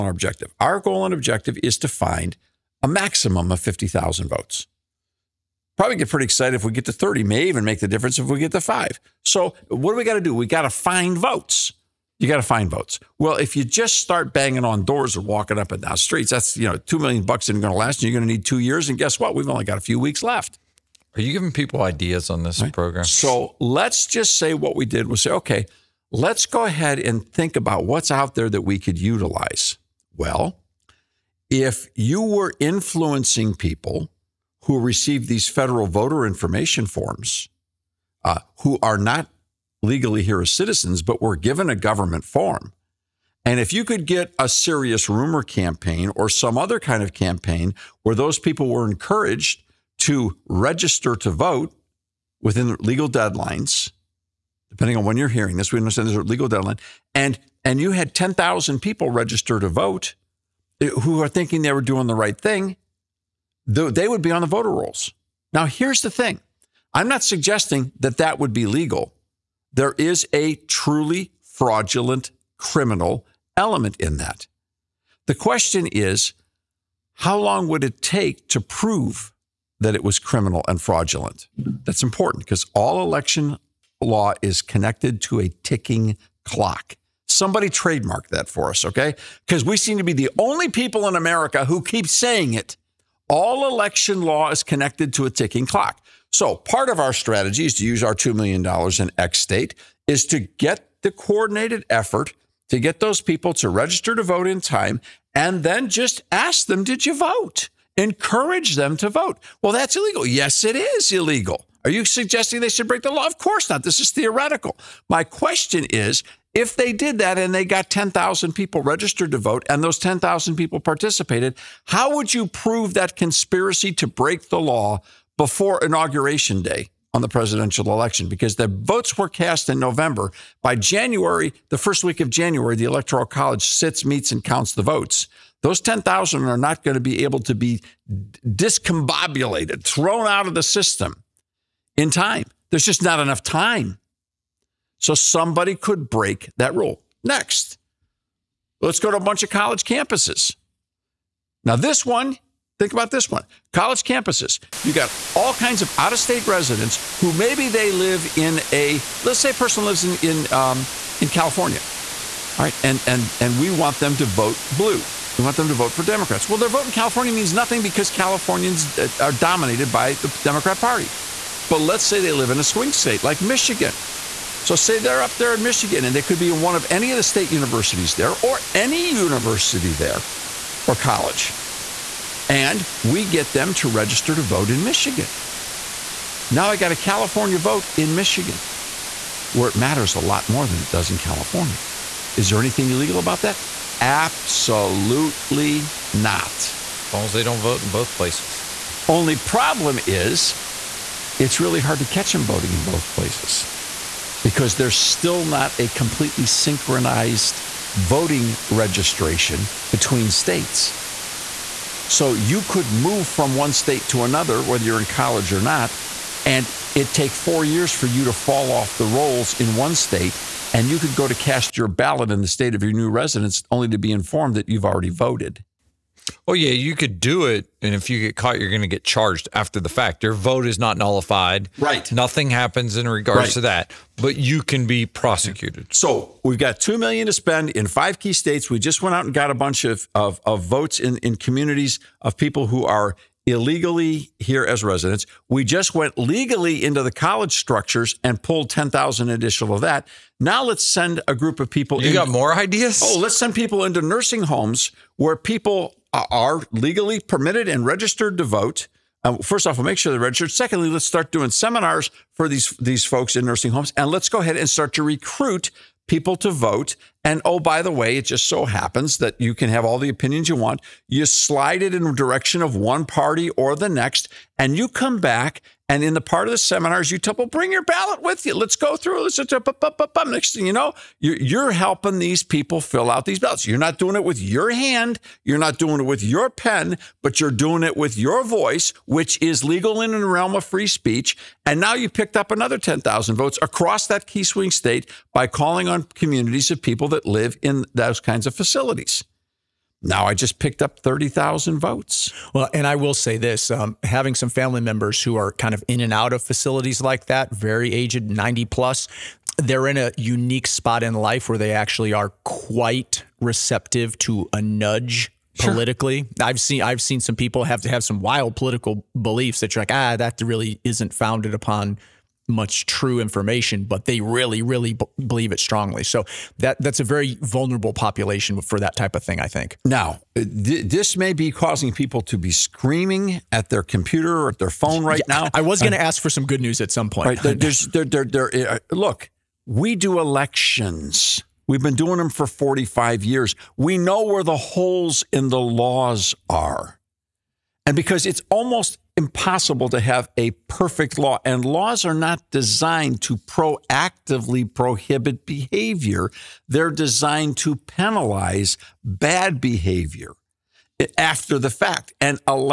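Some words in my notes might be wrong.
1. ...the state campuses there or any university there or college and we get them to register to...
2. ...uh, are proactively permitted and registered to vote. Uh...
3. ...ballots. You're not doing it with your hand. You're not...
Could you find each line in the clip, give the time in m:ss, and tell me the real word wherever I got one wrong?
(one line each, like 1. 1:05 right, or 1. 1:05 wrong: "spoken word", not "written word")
1. 2:57 wrong: "universities", not "campuses"
2. 4:16 wrong: "legally", not "proactively"
3. 4:43 right.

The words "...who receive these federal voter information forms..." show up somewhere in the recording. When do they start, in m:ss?
0:34.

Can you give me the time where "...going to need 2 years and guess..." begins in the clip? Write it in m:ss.
0:18.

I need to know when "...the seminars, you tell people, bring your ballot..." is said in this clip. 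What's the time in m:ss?
4:36.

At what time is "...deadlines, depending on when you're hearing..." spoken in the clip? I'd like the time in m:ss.
0:53.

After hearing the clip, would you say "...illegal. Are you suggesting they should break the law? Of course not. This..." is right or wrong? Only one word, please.
right.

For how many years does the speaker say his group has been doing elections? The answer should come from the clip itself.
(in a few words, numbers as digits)
45 years.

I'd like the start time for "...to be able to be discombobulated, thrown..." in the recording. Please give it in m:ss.
2:16.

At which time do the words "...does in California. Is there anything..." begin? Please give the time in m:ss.
3:10.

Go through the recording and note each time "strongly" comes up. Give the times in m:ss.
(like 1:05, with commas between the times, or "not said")
5:25.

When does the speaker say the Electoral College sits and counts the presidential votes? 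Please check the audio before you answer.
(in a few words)
first week of January.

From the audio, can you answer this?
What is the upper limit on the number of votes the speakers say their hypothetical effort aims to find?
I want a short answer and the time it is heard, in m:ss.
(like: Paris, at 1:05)
50,000, at 0:03.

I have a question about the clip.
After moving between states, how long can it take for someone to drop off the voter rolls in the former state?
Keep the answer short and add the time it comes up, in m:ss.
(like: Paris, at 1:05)
4 years, at 3:37.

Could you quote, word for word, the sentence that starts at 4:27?
And oh, by the way, it just so happens that you can have all the opinions you want.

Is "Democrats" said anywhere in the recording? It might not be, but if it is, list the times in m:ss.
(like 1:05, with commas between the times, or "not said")
2:46, 2:50.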